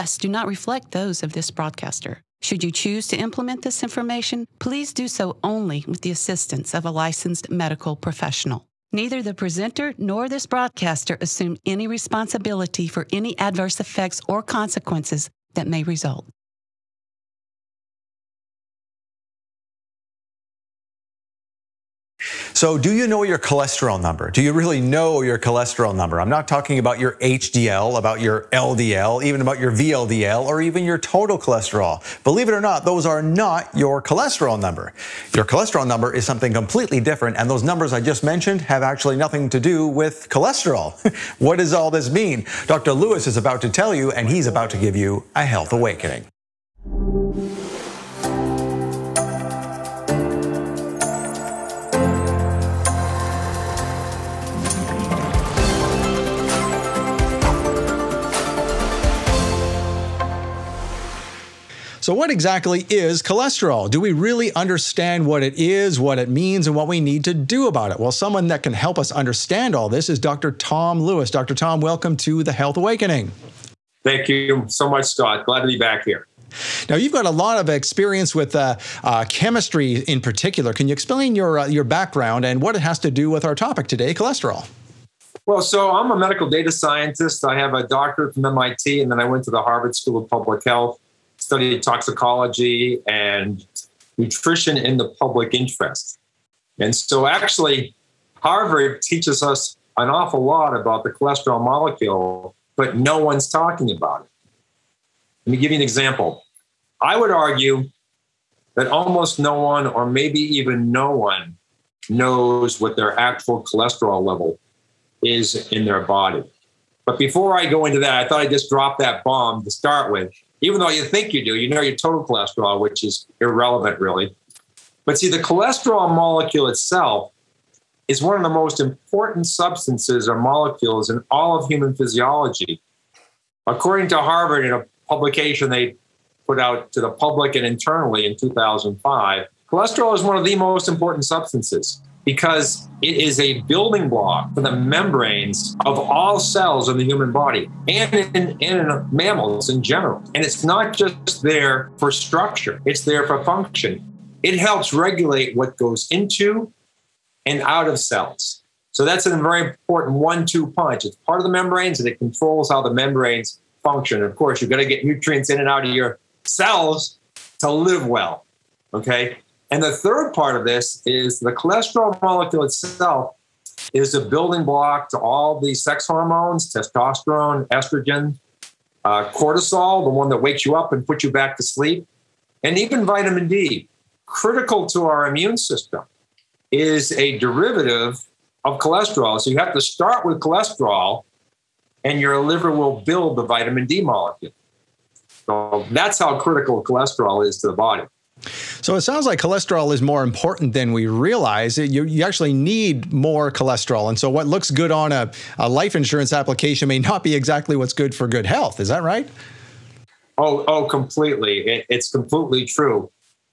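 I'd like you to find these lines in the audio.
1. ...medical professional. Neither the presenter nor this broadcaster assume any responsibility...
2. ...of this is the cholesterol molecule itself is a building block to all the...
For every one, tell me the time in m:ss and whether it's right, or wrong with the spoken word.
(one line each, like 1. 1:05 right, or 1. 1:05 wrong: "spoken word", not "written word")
1. 0:07 right
2. 2:50 right.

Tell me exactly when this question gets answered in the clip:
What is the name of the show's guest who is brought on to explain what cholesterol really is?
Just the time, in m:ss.
1:10.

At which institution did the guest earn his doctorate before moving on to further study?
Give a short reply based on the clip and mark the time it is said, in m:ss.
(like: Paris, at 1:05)
MIT, at 1:28.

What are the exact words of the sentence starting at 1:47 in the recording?
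I would argue that almost no one, or maybe even no one, knows what their actual cholesterol level is in their body.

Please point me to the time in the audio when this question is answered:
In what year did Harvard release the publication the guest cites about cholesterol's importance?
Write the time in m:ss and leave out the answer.
2:18.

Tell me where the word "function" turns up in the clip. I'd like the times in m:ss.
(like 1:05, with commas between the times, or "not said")
2:33, 2:43.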